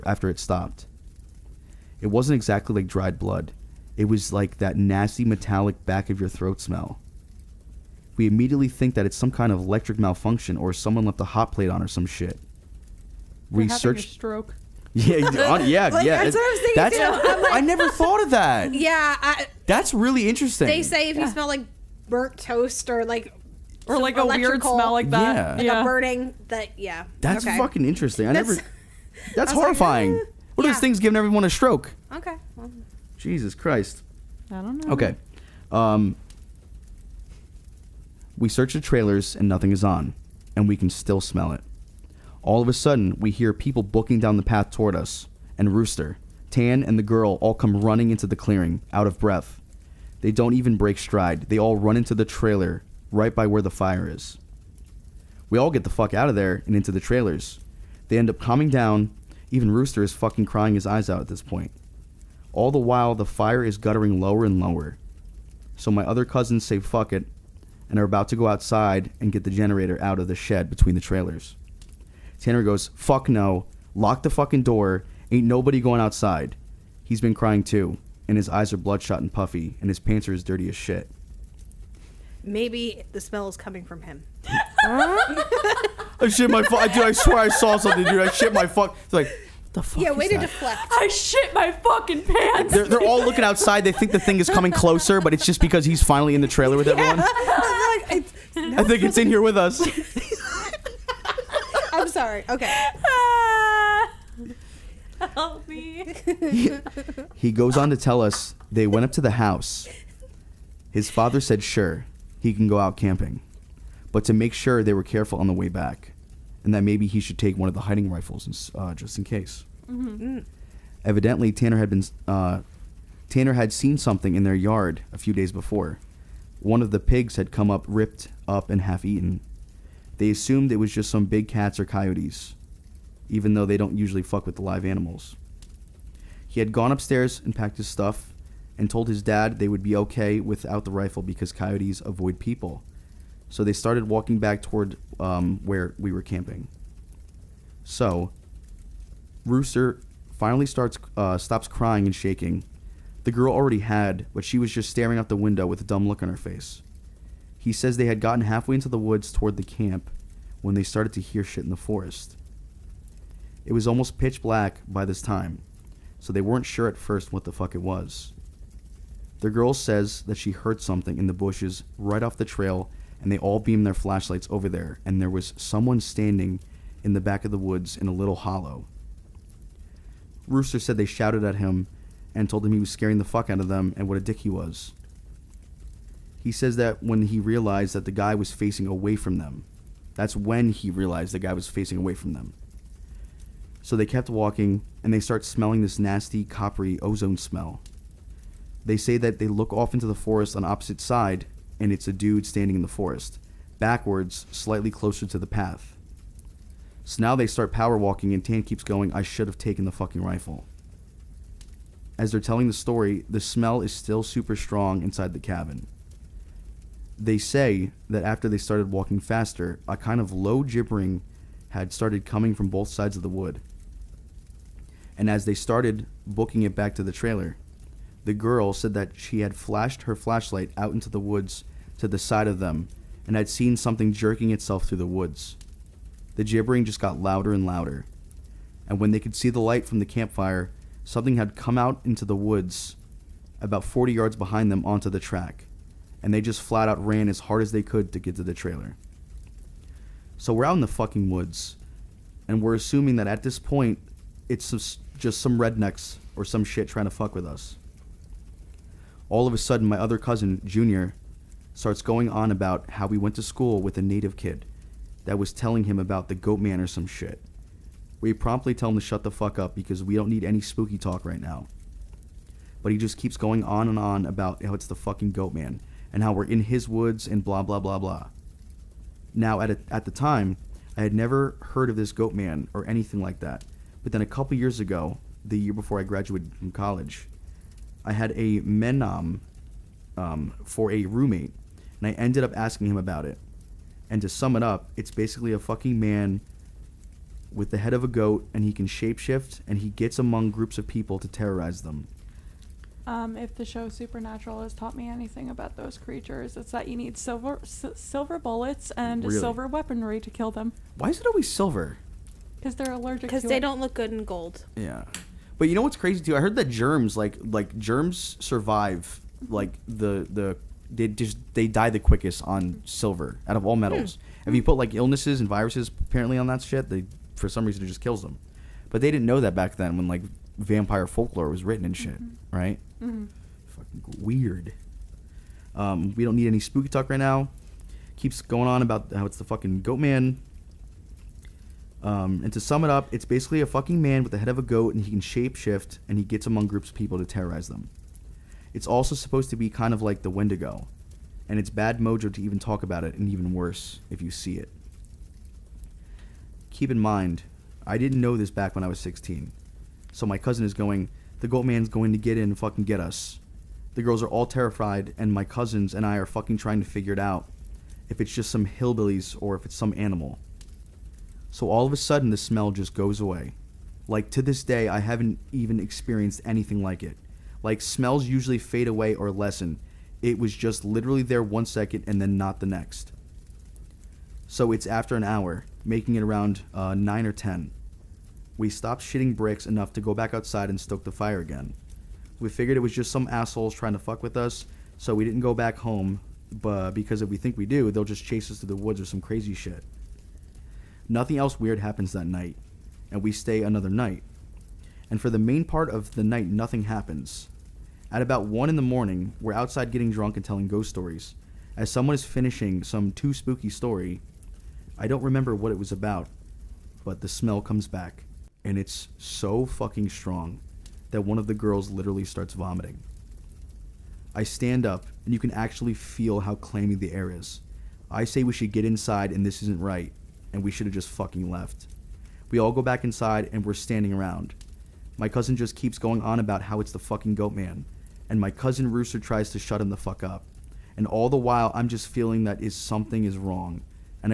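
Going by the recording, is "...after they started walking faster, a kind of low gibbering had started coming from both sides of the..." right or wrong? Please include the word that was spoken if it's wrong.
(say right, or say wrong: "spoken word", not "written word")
right.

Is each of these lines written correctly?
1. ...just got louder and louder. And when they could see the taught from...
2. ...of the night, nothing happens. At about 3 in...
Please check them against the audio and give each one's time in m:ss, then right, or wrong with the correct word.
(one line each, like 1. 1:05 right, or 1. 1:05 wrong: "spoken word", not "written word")
1. 3:56 wrong: "light", not "taught"
2. 6:45 wrong: "1", not "3".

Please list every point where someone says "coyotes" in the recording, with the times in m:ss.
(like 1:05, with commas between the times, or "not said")
2:11, 2:21.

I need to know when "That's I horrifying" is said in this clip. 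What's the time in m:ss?
0:29.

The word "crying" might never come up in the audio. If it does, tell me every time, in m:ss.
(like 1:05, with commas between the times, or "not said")
1:00, 1:17, 2:31.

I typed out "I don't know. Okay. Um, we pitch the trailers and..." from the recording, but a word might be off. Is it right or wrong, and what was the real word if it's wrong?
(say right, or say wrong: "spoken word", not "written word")
wrong: "search", not "pitch".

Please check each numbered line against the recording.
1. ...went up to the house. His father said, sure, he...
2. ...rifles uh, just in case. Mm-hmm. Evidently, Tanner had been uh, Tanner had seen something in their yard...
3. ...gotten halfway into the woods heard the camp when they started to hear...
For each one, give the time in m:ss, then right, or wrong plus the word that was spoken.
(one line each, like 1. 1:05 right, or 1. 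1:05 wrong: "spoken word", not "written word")
1. 1:48 right
2. 1:58 right
3. 2:38 wrong: "toward", not "heard".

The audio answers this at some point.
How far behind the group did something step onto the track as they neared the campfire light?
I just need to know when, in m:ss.
4:03.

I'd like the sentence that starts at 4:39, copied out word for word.
Now at a, at the time, I had never heard of this goat man or anything like that.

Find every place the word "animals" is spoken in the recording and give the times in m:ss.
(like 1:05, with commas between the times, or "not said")
2:14, 6:09.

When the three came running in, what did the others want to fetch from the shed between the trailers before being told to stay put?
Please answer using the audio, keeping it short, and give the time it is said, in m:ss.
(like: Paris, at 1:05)
generator, at 1:09.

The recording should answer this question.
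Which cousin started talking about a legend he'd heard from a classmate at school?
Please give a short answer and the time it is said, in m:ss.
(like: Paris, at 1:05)
Junior, at 4:20.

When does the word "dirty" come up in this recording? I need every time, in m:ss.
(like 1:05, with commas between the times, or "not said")
1:20.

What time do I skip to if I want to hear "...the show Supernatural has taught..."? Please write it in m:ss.
5:03.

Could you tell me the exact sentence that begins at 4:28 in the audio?
We promptly tell him to shut the fuck up because we don't need any spooky talk right now.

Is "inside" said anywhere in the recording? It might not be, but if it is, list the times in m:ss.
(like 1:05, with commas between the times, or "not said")
3:35, 7:08, 7:13.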